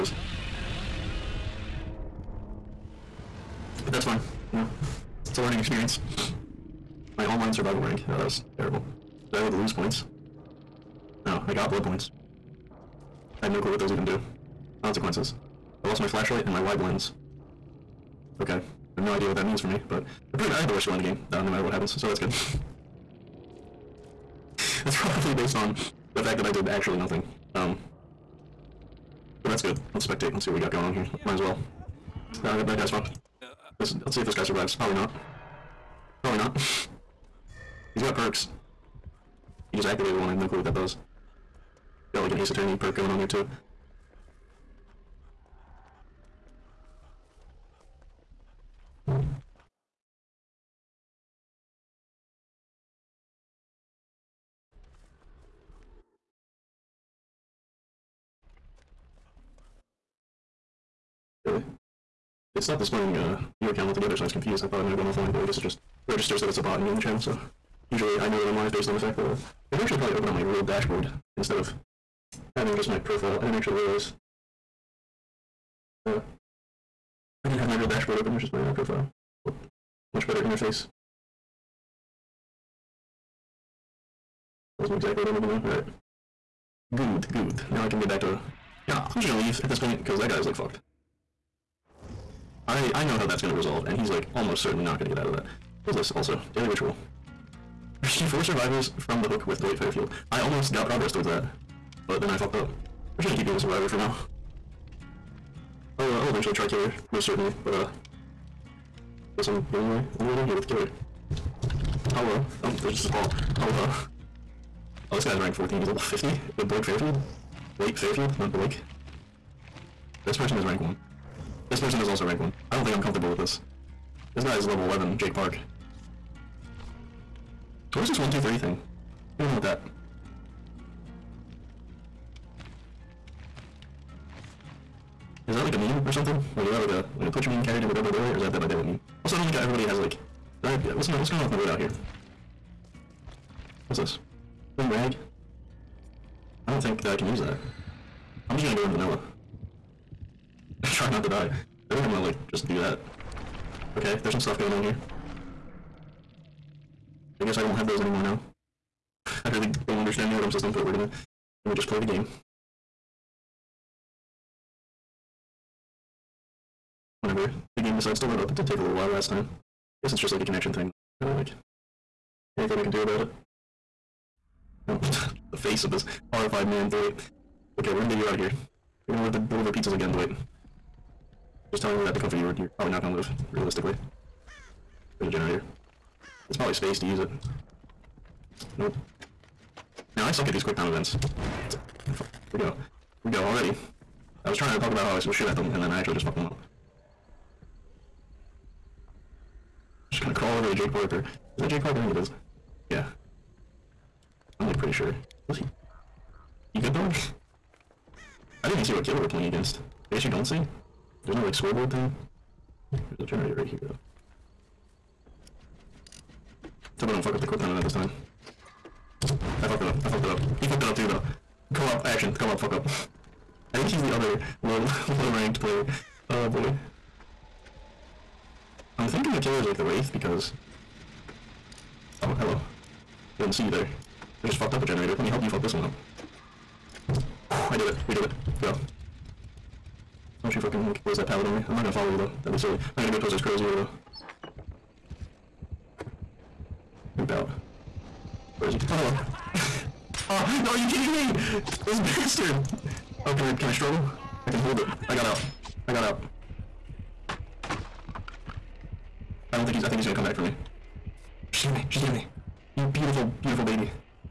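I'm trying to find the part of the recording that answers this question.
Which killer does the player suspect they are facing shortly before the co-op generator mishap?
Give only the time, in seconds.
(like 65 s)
229 s.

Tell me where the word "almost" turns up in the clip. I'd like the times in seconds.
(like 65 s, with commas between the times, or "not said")
94 s, 100 s.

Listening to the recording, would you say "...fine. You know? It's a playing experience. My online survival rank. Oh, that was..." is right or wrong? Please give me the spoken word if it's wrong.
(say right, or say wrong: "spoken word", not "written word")
wrong: "learning", not "playing".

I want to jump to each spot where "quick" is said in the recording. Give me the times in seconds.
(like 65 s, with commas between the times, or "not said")
190 s, 217 s.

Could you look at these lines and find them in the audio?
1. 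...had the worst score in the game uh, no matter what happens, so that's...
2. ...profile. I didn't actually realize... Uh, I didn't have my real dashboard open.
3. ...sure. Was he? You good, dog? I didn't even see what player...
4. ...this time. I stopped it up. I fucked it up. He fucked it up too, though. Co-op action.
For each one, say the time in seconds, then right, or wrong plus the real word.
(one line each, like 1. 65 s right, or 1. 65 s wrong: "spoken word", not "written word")
1. 20 s right
2. 72 s right
3. 204 s wrong: "killer", not "player"
4. 217 s wrong: "fucked", not "stopped".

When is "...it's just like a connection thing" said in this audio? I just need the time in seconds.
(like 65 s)
170 s.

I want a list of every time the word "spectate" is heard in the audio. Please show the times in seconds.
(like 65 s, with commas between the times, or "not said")
30 s.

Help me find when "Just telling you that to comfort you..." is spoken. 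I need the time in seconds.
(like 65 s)
181 s.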